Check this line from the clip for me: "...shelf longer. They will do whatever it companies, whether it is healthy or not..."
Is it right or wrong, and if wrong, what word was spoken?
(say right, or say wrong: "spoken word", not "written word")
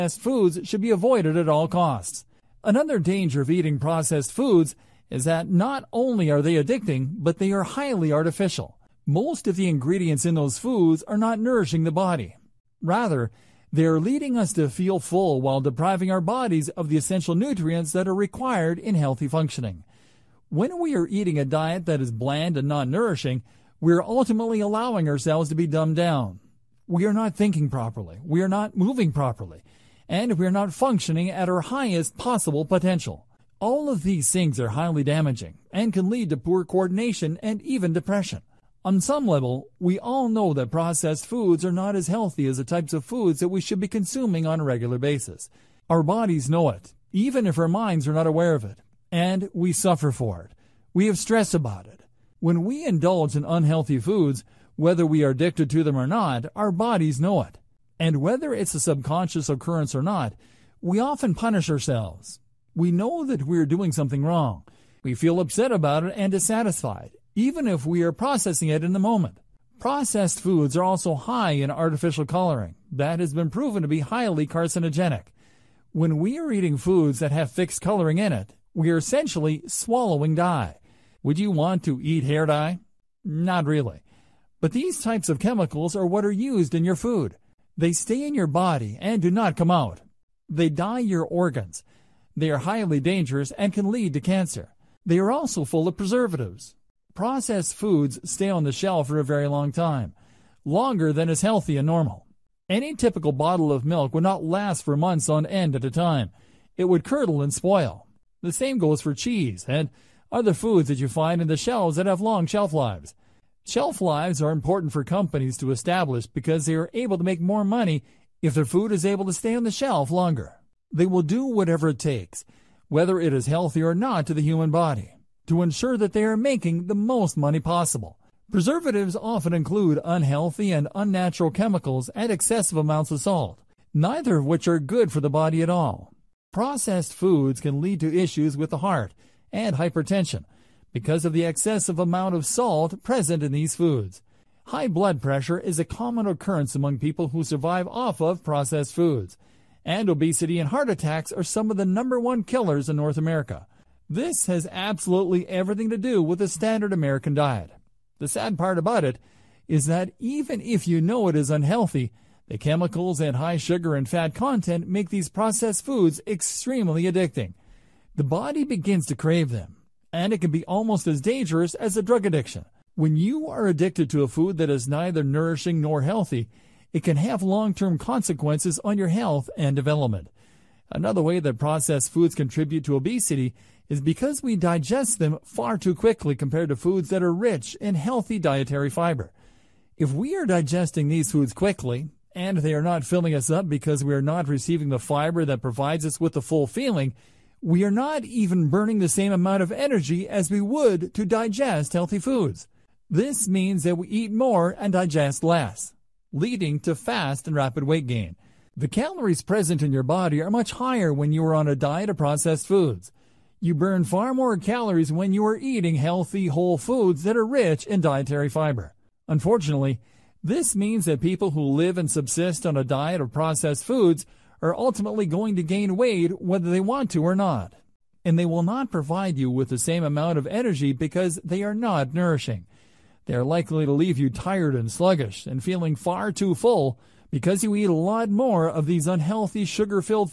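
wrong: "takes", not "companies".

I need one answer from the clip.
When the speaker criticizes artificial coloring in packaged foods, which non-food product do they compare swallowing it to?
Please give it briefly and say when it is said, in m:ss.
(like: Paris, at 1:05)
Hair dye, at 1:22.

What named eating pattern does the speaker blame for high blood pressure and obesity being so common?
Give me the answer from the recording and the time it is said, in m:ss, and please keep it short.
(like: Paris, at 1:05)
Standard American diet, at 2:36.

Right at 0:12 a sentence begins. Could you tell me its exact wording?
Rather, they are leading us to feel full while depriving our bodies of the essential nutrients that are required in healthy functioning.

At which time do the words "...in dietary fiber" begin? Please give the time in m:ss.
3:37.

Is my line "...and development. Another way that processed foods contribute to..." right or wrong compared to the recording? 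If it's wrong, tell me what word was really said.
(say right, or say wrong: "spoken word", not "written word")
right.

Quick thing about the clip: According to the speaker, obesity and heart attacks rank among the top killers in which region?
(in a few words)
North America.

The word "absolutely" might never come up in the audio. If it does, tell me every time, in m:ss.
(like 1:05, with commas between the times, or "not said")
2:34.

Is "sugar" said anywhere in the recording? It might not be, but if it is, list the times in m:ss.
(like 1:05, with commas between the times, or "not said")
2:43, 3:59.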